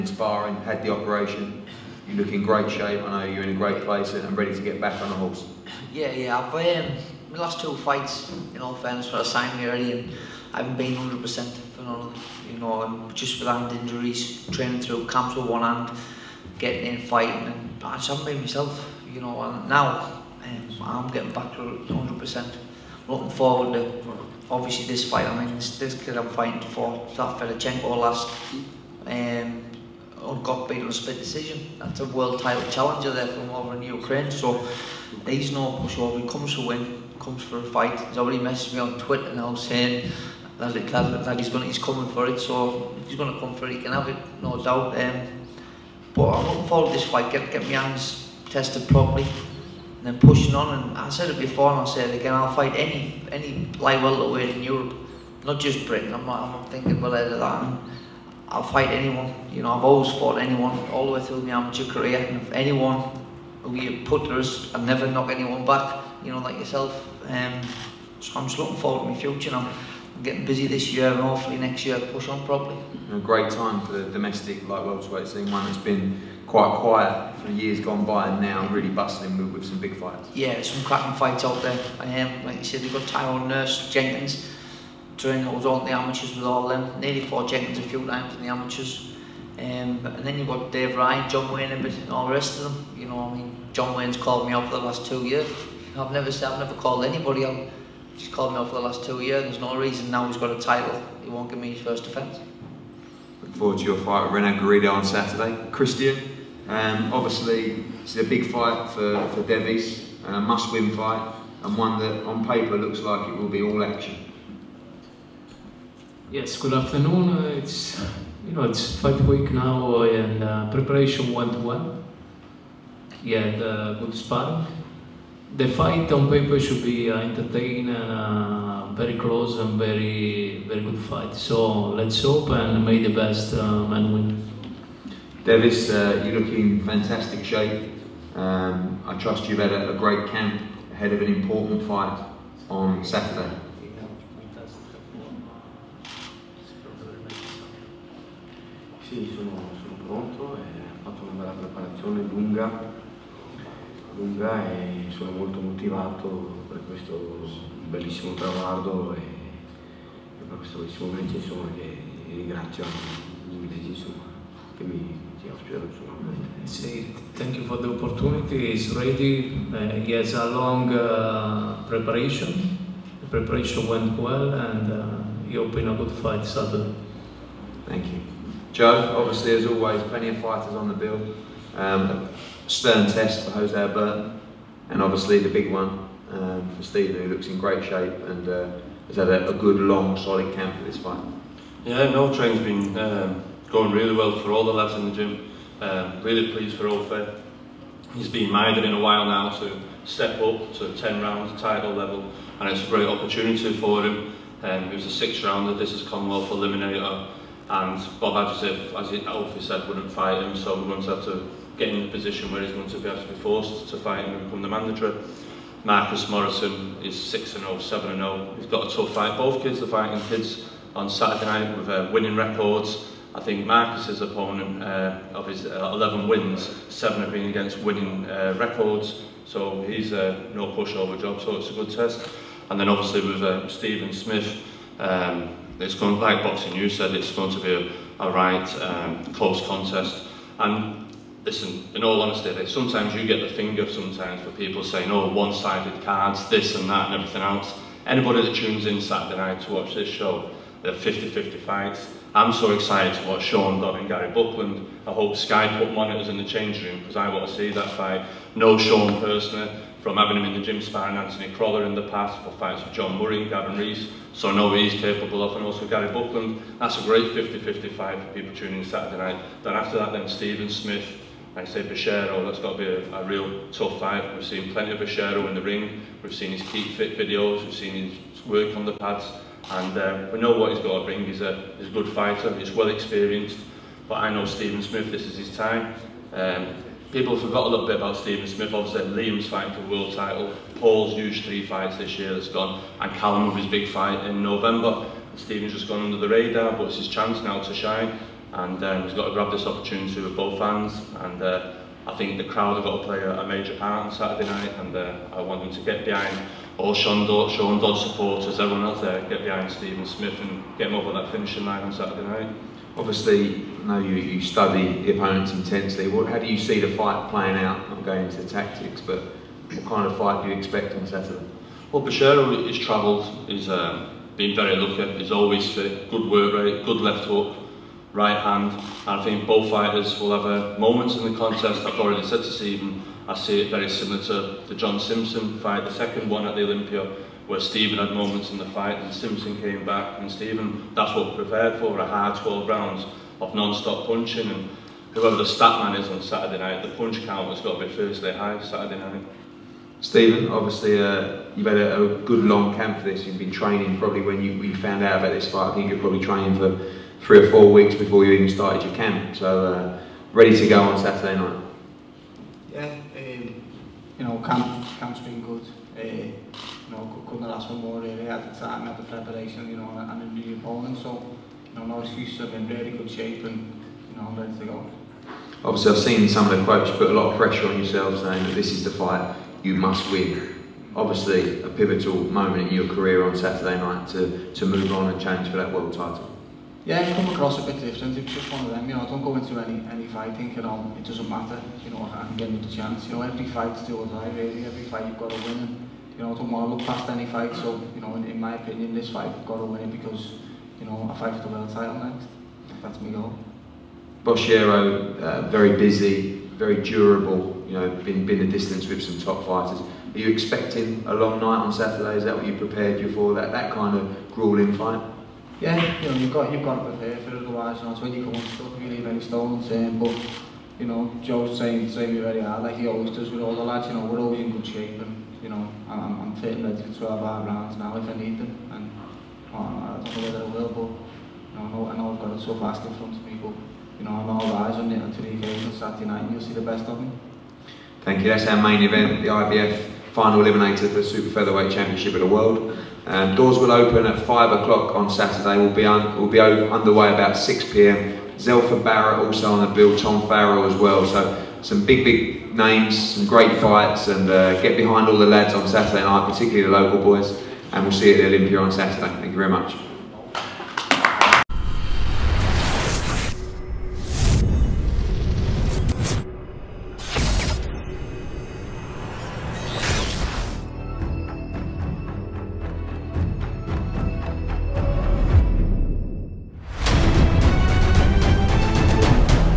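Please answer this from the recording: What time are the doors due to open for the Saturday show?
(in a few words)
5 o'clock.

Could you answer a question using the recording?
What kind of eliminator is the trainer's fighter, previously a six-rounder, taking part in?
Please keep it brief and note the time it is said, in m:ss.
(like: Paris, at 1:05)
Commonwealth Eliminator, at 3:26.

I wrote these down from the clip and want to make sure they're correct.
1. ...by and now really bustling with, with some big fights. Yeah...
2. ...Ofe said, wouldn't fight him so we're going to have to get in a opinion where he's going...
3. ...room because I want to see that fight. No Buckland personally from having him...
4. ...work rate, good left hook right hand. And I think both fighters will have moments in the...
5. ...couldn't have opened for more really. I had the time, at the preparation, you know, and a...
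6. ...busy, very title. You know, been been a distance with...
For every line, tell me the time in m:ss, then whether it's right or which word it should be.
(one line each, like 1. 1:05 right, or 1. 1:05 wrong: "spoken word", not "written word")
1. 1:18 right
2. 3:29 wrong: "position", not "opinion"
3. 4:16 wrong: "Sean", not "Buckland"
4. 5:26 right
5. 6:07 wrong: "asked", not "opened"
6. 6:45 wrong: "durable", not "title".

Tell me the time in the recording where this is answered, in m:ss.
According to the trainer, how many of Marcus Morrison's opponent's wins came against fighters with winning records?
3:46.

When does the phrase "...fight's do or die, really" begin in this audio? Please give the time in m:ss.
6:33.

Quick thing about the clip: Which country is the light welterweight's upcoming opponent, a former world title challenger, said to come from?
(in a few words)
Ukraine.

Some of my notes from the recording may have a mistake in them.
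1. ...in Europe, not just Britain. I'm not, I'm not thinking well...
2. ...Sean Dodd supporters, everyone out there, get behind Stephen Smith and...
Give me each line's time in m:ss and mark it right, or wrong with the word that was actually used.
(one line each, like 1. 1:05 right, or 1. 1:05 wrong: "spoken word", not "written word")
1. 0:54 right
2. 5:07 right.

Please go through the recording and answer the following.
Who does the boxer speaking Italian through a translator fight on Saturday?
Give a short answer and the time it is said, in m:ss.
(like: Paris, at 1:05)
Renald Garrido, at 1:44.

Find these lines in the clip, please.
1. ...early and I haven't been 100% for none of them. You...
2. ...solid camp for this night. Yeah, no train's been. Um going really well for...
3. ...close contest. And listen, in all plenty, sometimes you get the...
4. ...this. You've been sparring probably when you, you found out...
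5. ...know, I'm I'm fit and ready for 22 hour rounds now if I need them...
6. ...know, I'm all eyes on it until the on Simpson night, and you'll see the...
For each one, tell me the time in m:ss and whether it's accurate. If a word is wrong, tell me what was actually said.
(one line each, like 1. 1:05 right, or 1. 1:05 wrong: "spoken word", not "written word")
1. 0:09 right
2. 3:10 wrong: "fight", not "night"
3. 3:59 wrong: "honesty", not "plenty"
4. 5:53 wrong: "training", not "sparring"
5. 7:05 wrong: "12", not "22"
6. 7:14 wrong: "Saturday", not "Simpson".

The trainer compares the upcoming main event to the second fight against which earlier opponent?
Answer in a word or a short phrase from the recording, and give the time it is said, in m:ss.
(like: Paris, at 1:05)
John Simpson, at 5:34.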